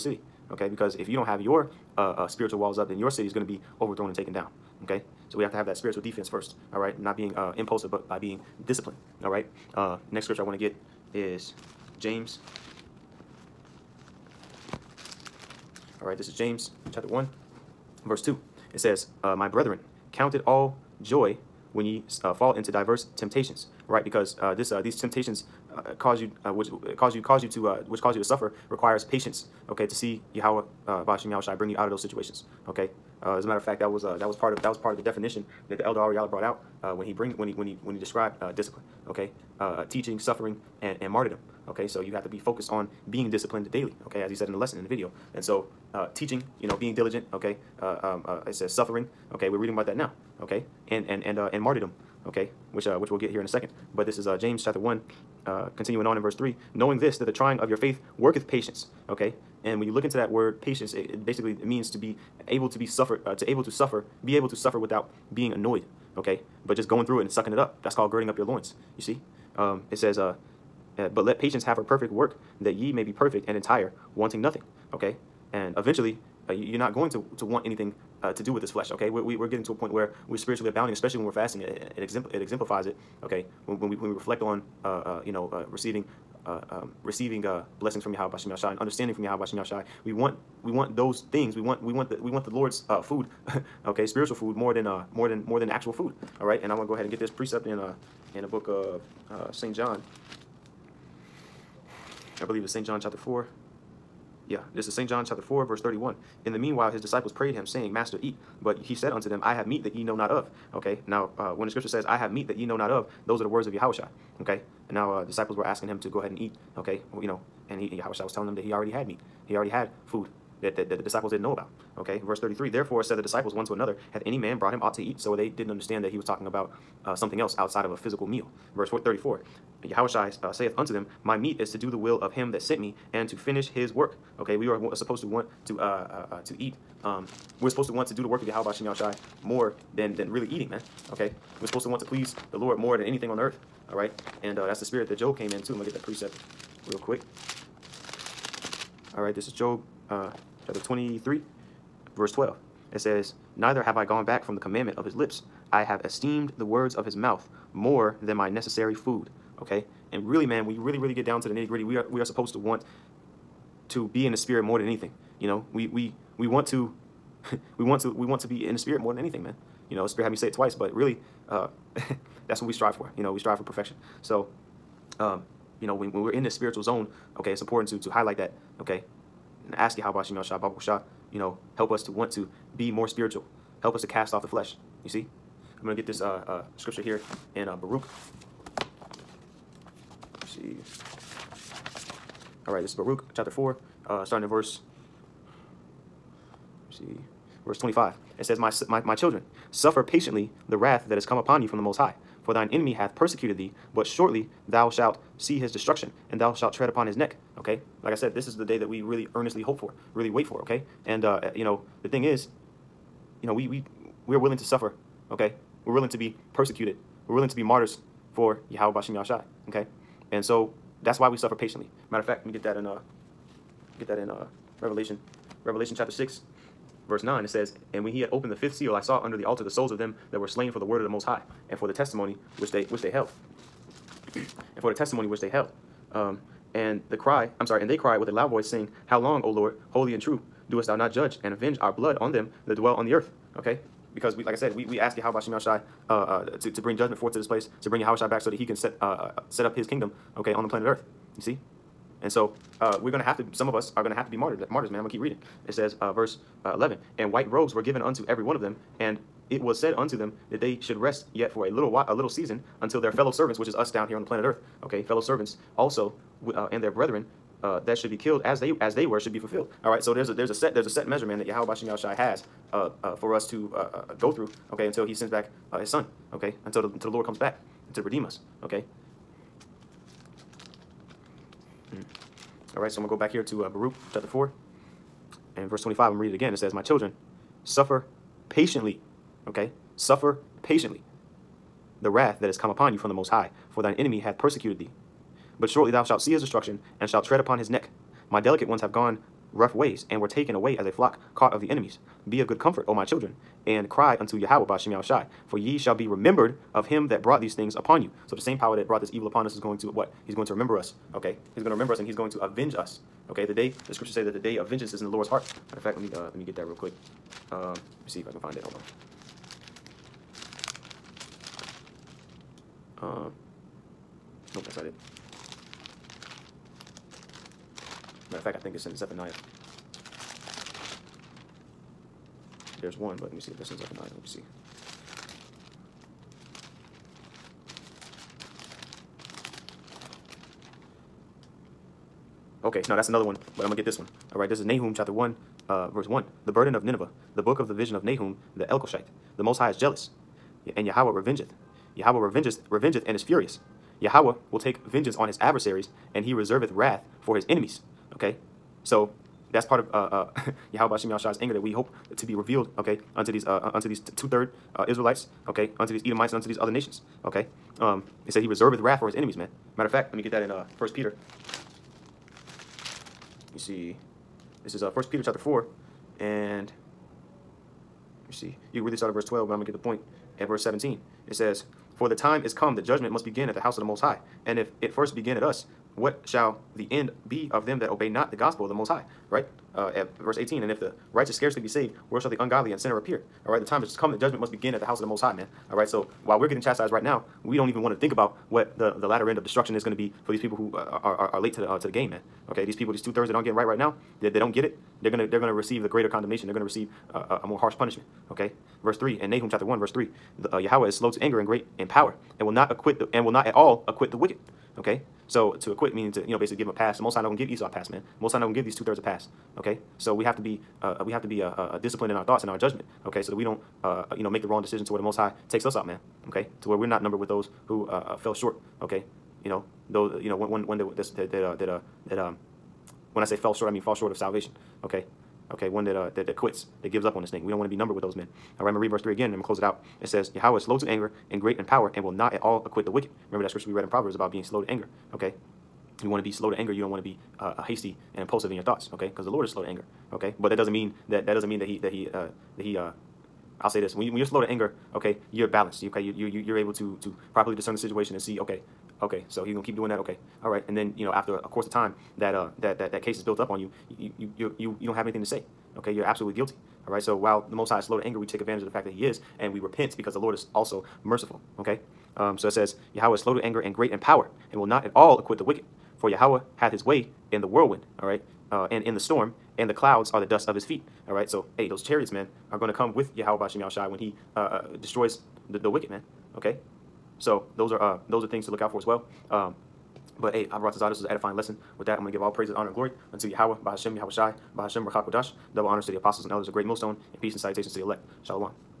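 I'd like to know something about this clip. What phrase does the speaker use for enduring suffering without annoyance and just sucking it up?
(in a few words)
girding up your loins.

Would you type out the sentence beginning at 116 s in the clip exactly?
Okay, well, you know, and he and Yahushua was telling them that he already had meat.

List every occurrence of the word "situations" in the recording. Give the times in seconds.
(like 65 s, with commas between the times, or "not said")
32 s, 457 s.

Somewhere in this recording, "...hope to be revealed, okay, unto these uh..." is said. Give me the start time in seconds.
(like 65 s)
361 s.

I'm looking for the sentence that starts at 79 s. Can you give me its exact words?
We're, we, are we are getting to a point where we're spiritually abounding, especially when we're fasting.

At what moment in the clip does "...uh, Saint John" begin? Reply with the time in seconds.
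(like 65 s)
99 s.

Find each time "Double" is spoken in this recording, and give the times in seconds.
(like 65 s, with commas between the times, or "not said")
495 s.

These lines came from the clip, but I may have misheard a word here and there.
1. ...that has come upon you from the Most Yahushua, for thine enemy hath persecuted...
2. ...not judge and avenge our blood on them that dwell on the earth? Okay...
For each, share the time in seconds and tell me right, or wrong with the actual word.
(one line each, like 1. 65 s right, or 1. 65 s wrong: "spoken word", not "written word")
1. 201 s wrong: "High", not "Yahushua"
2. 240 s right.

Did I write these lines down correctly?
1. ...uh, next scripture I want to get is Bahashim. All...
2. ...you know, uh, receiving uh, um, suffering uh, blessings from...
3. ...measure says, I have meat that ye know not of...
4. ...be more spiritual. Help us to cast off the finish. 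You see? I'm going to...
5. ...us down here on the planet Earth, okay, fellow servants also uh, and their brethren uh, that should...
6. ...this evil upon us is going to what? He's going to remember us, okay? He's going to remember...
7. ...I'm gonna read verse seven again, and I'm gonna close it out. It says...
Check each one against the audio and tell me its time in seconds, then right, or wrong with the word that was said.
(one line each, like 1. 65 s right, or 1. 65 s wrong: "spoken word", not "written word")
1. 9 s wrong: "James", not "Bahashim"
2. 85 s wrong: "receiving", not "suffering"
3. 111 s wrong: "scripture", not "measure"
4. 182 s wrong: "flesh", not "finish"
5. 263 s right
6. 308 s right
7. 438 s wrong: "three", not "seven".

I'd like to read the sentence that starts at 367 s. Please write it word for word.
Um, it said he reserveth wrath for his enemies, man.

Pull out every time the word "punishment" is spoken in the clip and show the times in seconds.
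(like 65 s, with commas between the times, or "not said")
407 s.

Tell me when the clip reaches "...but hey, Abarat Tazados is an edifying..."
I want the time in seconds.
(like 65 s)
490 s.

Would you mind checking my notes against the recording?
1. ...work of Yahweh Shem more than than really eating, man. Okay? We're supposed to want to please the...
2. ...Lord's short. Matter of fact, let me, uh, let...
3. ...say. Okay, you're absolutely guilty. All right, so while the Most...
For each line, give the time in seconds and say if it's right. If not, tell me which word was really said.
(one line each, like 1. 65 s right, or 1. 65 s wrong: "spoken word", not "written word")
1. 138 s right
2. 315 s wrong: "heart", not "short"
3. 465 s right.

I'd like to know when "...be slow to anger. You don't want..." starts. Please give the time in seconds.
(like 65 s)
446 s.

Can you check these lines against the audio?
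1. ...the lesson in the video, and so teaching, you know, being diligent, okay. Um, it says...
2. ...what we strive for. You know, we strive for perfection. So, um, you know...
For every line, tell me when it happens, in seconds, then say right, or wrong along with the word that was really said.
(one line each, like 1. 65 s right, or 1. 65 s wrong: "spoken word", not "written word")
1. 44 s right
2. 172 s right.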